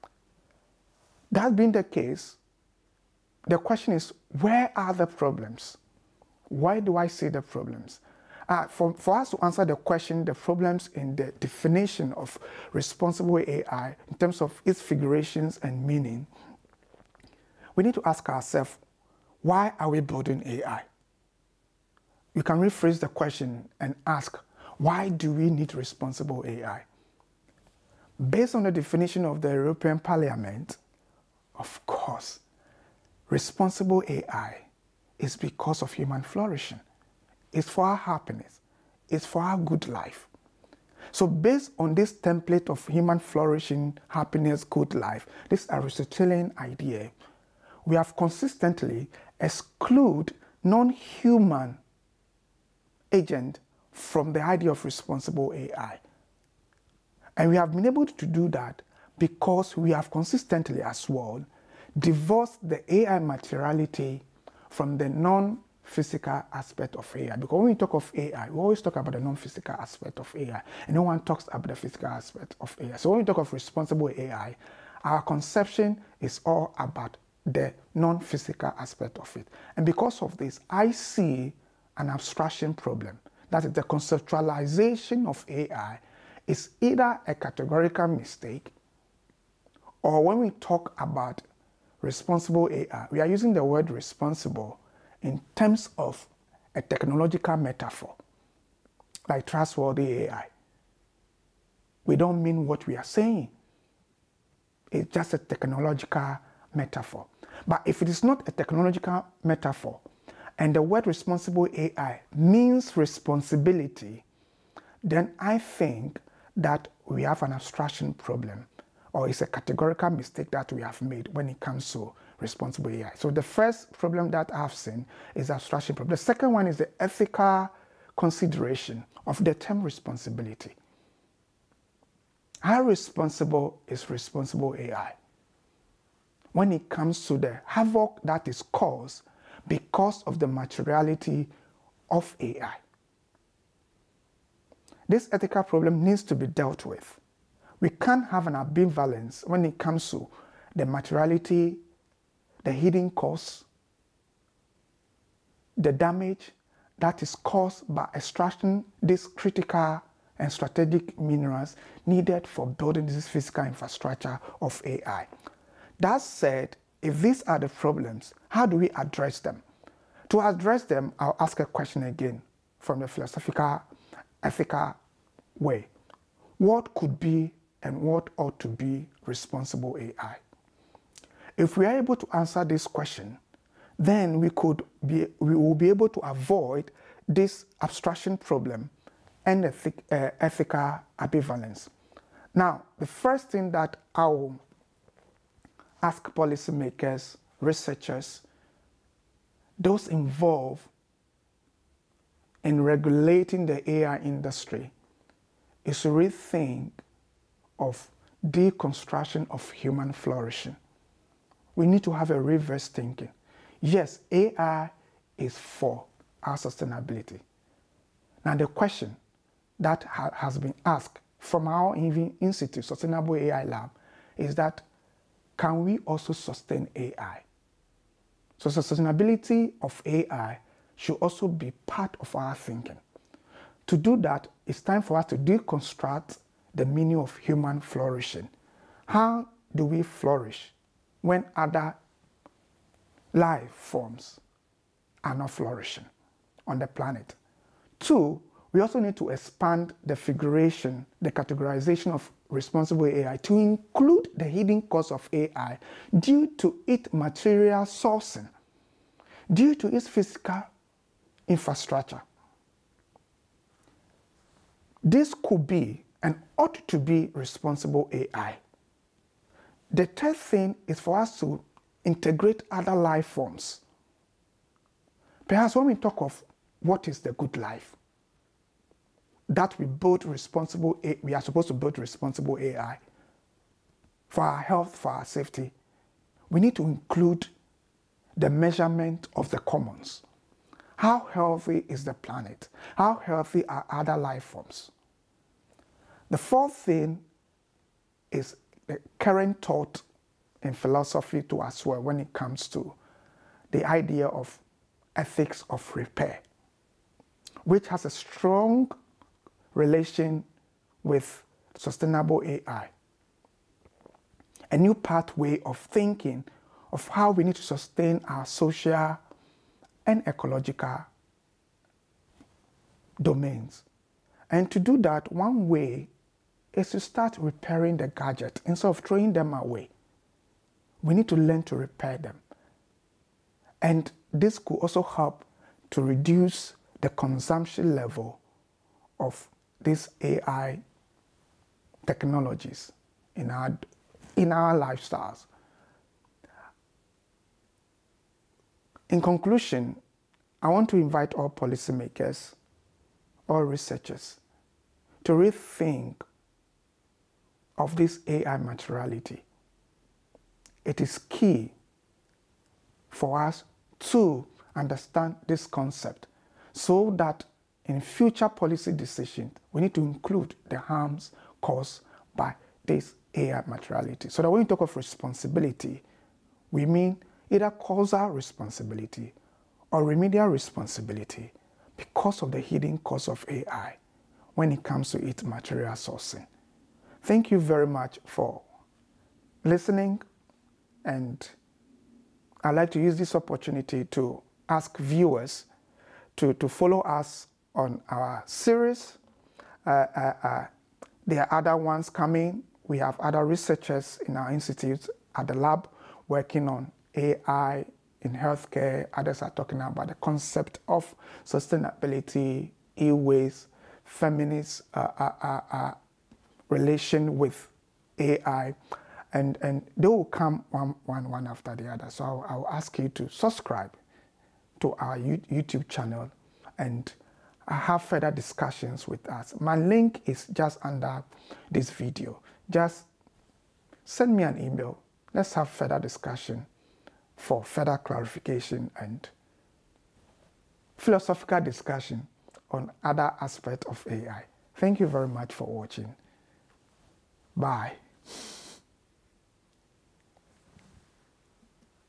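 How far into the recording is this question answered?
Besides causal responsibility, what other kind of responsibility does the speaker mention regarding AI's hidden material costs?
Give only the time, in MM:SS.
06:20.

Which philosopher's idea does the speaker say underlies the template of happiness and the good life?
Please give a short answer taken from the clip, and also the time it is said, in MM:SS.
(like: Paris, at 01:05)
Aristotelian, at 00:45.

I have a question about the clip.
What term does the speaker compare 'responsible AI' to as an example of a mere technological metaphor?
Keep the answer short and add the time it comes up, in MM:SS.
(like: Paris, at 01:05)
trustworthy AI, at 01:39.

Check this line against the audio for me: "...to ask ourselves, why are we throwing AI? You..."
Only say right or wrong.
wrong.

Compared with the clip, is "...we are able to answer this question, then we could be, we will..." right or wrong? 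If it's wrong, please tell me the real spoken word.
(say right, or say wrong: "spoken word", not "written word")
right.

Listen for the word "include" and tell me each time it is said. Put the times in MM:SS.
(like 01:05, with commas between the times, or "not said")
04:13, 04:46, 06:10.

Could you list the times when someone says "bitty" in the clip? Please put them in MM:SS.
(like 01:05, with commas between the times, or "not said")
not said.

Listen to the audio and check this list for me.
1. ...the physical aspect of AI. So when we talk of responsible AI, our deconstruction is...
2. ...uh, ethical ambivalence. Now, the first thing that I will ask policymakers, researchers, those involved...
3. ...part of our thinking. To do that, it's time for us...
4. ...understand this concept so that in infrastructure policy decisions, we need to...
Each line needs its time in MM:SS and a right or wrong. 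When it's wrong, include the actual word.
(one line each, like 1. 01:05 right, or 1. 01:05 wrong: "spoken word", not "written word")
1. 01:11 wrong: "conception", not "deconstruction"
2. 03:09 right
3. 03:51 right
4. 06:04 wrong: "future", not "infrastructure".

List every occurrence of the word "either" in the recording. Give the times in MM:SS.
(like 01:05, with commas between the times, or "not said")
01:26, 06:17.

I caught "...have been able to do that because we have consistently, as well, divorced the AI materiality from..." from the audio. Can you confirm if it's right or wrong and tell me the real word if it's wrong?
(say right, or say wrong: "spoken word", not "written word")
right.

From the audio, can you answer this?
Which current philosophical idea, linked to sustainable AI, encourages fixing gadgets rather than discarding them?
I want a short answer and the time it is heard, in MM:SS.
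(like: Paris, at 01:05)
ethics of repair, at 05:05.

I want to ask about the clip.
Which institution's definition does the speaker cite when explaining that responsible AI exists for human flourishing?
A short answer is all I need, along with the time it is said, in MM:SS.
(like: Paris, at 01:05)
European Parliament, at 00:29.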